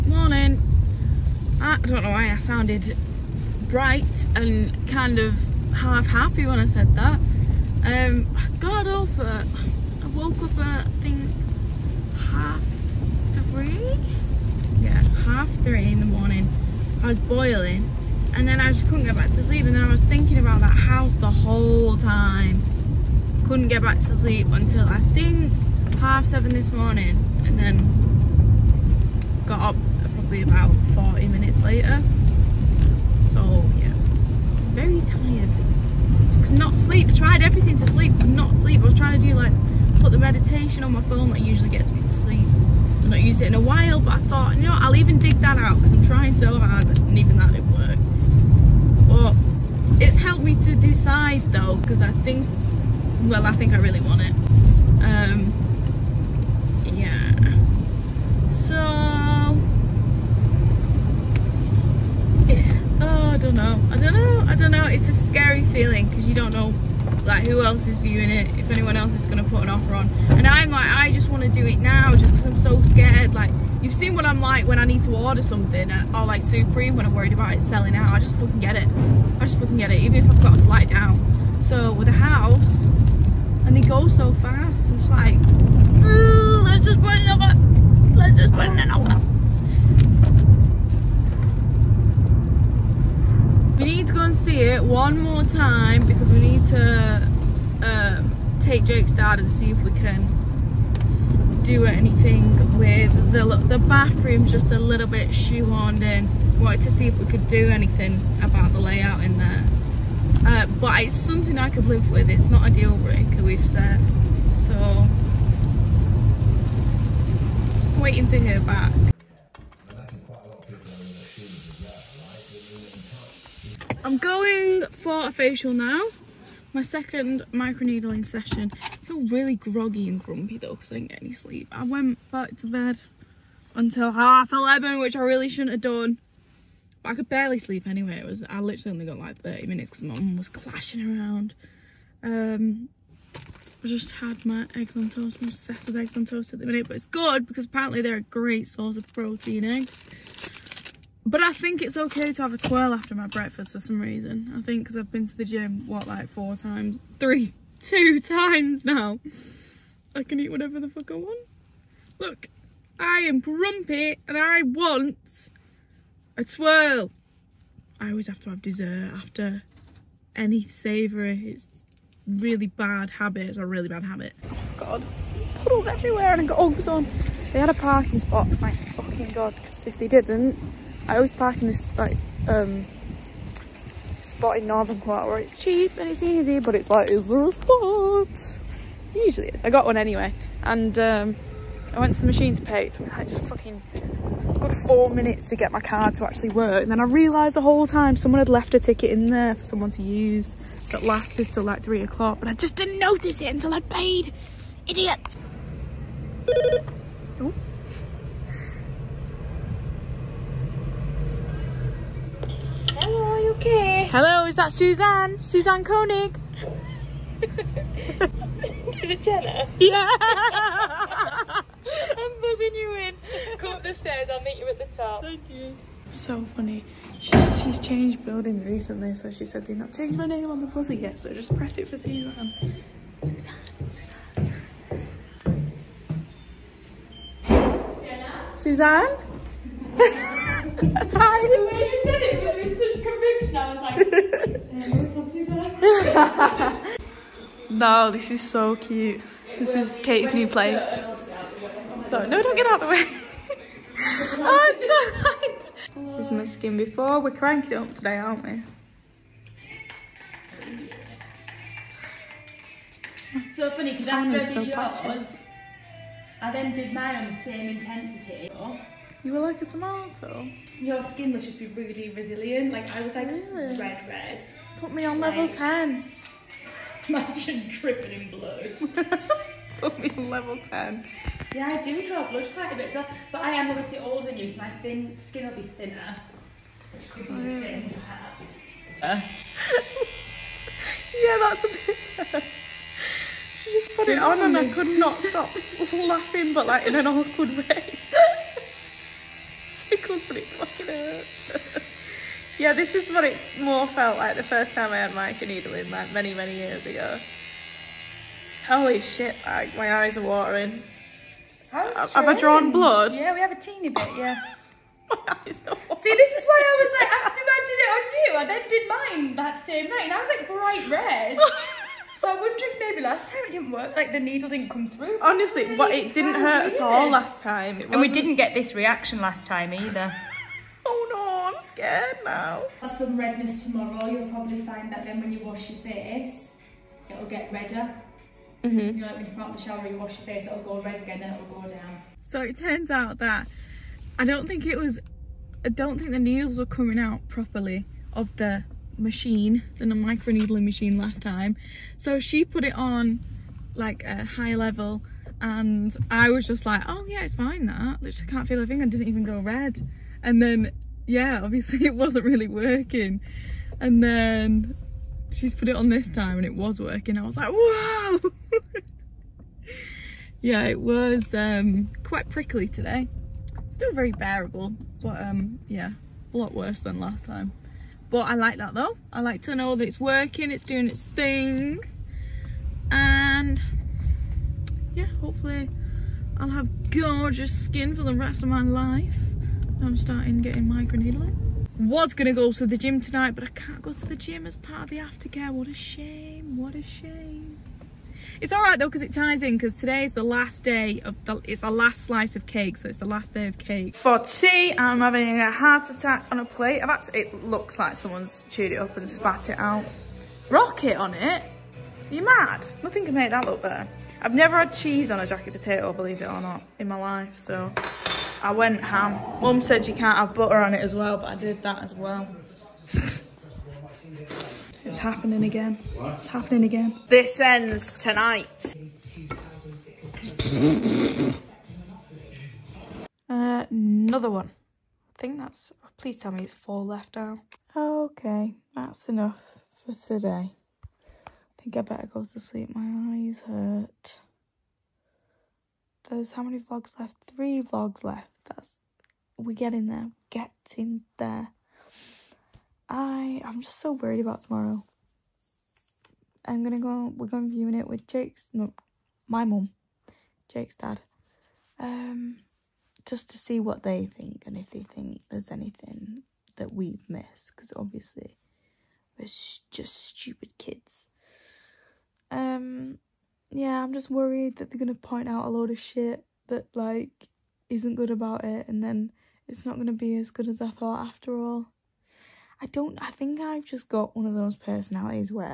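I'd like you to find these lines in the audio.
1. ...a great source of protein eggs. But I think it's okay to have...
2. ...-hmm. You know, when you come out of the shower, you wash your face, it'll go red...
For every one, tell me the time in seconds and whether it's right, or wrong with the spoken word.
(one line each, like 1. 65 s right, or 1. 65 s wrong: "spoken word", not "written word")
1. 148 s right
2. 338 s right.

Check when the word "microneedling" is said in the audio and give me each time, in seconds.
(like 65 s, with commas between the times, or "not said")
127 s, 305 s, 349 s.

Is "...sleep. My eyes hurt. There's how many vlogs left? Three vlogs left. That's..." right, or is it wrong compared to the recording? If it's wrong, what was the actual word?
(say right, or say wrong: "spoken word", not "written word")
right.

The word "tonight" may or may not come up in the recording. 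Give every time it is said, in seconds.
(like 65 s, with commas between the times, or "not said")
392 s, 428 s.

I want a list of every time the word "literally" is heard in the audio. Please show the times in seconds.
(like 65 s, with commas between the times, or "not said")
138 s.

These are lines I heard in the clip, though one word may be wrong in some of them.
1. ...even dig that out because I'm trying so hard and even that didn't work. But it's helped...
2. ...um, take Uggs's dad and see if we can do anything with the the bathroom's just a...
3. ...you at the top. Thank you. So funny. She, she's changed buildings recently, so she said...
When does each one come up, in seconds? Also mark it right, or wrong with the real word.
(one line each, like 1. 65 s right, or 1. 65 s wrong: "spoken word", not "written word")
1. 44 s right
2. 97 s wrong: "Jake", not "Uggs"
3. 224 s right.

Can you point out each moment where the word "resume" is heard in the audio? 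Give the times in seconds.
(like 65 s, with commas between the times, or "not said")
not said.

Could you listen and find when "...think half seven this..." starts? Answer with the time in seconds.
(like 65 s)
25 s.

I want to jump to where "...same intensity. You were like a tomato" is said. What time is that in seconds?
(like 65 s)
267 s.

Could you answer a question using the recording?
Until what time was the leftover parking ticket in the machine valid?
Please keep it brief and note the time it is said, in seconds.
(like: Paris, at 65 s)
3 o'clock, at 201 s.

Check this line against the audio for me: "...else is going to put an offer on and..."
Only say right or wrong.
right.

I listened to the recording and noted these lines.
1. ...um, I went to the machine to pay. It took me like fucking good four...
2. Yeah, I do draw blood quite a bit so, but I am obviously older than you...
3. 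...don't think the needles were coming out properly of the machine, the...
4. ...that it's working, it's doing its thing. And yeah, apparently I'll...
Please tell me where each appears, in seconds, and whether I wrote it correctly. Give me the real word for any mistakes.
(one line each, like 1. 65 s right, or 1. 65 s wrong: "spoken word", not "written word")
1. 190 s right
2. 281 s right
3. 345 s right
4. 379 s wrong: "hopefully", not "apparently".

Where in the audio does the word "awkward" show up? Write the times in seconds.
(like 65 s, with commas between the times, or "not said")
297 s.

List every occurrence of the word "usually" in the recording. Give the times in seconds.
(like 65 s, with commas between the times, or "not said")
41 s, 189 s.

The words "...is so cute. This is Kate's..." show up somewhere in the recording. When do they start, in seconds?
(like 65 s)
248 s.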